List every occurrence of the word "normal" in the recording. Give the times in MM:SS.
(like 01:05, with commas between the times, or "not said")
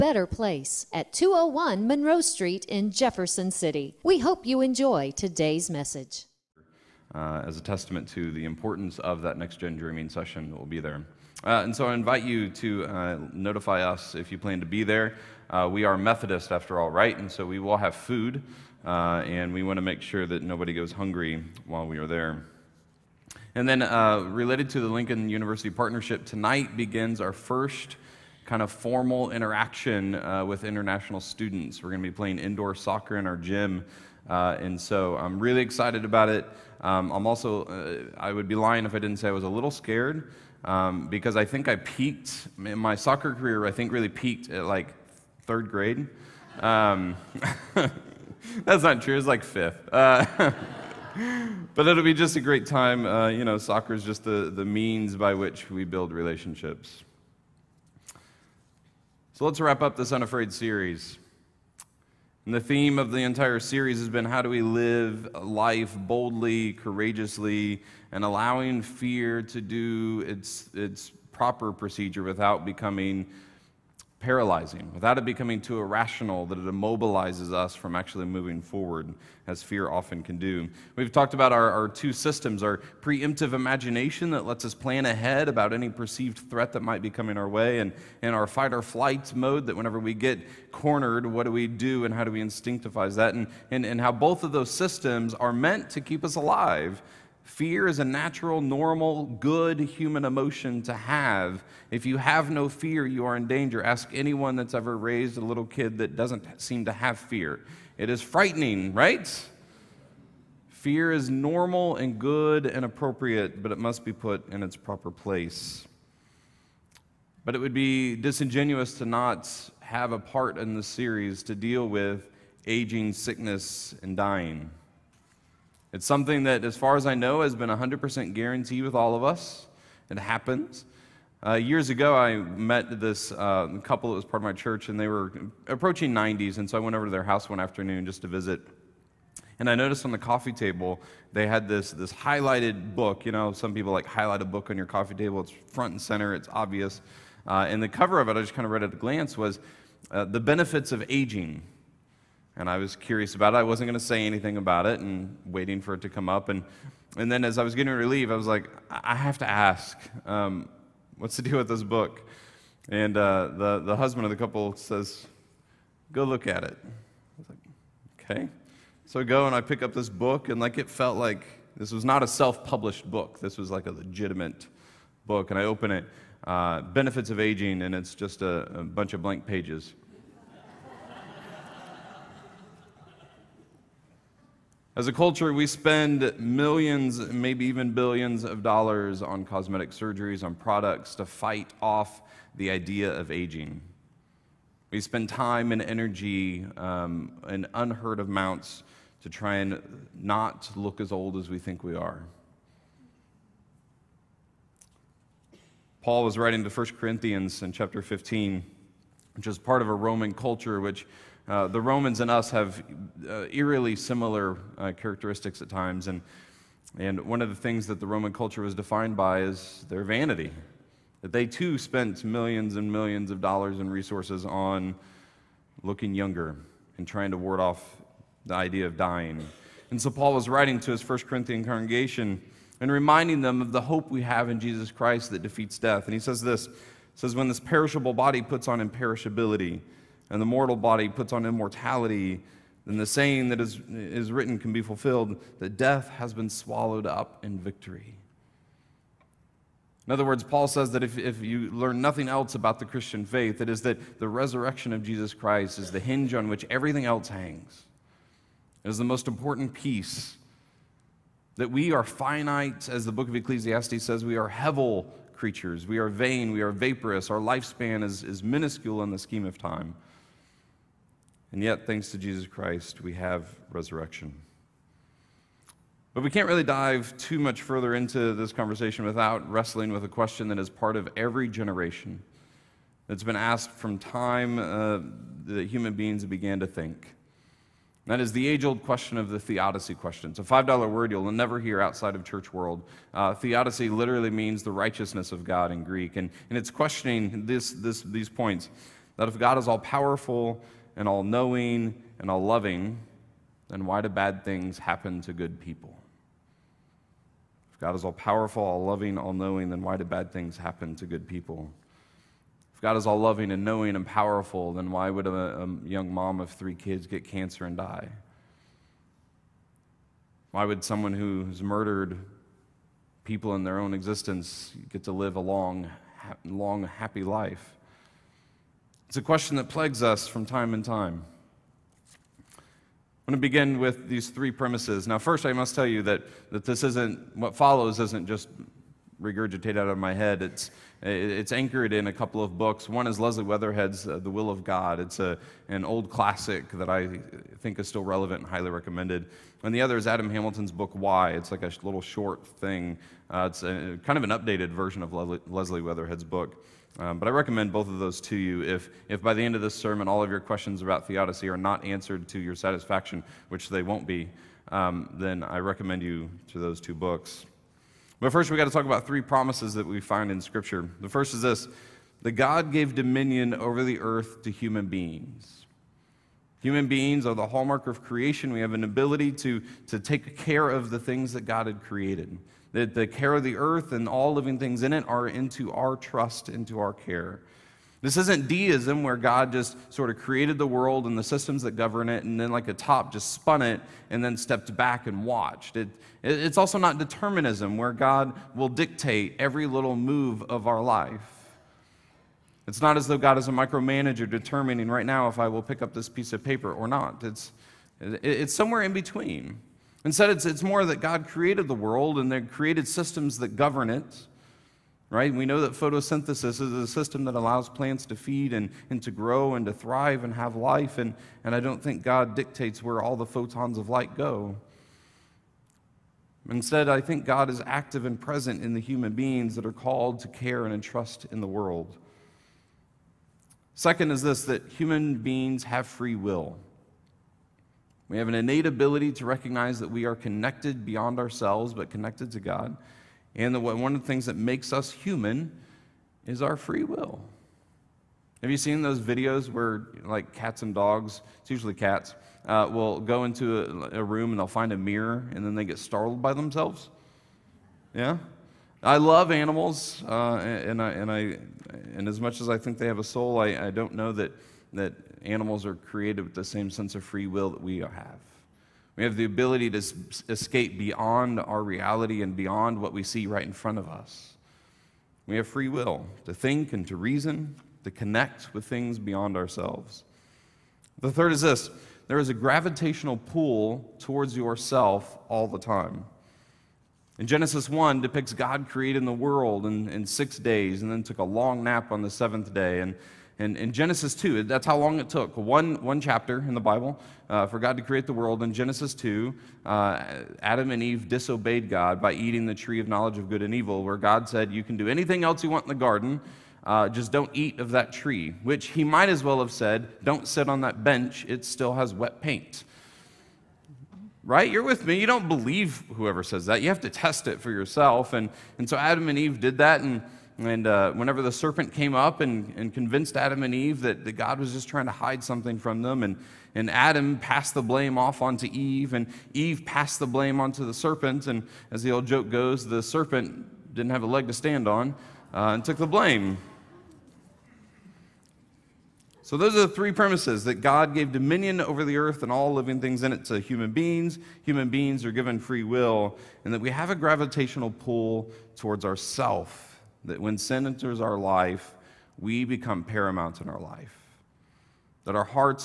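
01:38, 01:51.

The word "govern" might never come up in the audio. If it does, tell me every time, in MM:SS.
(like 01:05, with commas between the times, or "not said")
06:31, 06:53.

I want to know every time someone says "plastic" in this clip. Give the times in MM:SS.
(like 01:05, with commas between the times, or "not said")
not said.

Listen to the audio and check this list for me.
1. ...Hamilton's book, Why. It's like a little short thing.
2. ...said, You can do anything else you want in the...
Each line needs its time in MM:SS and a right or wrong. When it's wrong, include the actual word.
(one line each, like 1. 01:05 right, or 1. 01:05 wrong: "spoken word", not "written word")
1. 05:50 right
2. 08:24 right.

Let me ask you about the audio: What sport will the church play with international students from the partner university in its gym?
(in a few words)
Indoor soccer.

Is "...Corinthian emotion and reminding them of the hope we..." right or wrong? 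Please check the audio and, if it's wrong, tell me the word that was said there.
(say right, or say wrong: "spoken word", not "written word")
wrong: "congregation", not "emotion".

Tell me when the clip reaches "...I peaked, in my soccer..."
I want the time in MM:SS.
00:41.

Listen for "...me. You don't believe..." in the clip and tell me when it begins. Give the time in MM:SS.
08:34.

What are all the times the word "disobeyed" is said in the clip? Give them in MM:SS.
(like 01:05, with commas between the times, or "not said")
08:21.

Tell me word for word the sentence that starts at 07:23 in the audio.
And that one of the things that makes us human is our free will.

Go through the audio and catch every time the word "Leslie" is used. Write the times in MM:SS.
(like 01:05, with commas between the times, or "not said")
05:43, 05:55.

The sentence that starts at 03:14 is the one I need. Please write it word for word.
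We spend time and energy um, in unheard of amounts to try and not look as old as we think we are.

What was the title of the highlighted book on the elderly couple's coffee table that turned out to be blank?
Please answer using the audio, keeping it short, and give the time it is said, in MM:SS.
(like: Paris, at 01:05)
The Benefits of Aging, at 02:30.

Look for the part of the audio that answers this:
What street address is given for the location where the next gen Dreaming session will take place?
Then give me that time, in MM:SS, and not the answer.
00:01.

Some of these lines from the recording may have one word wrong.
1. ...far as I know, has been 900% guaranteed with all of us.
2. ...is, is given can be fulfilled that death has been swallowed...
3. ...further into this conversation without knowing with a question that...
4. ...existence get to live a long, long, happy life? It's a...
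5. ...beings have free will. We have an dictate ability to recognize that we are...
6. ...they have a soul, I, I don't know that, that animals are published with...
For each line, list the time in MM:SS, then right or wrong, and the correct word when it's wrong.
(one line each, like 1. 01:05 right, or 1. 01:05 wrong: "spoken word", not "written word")
1. 02:06 wrong: "100", not "900"
2. 04:03 wrong: "written", not "given"
3. 04:37 wrong: "wrestling", not "knowing"
4. 05:23 right
5. 07:15 wrong: "innate", not "dictate"
6. 07:42 wrong: "created", not "published".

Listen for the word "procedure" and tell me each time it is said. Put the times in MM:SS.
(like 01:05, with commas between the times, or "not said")
01:11.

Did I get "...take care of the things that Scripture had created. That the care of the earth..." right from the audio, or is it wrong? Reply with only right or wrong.
wrong.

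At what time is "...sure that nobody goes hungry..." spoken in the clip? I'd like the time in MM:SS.
00:20.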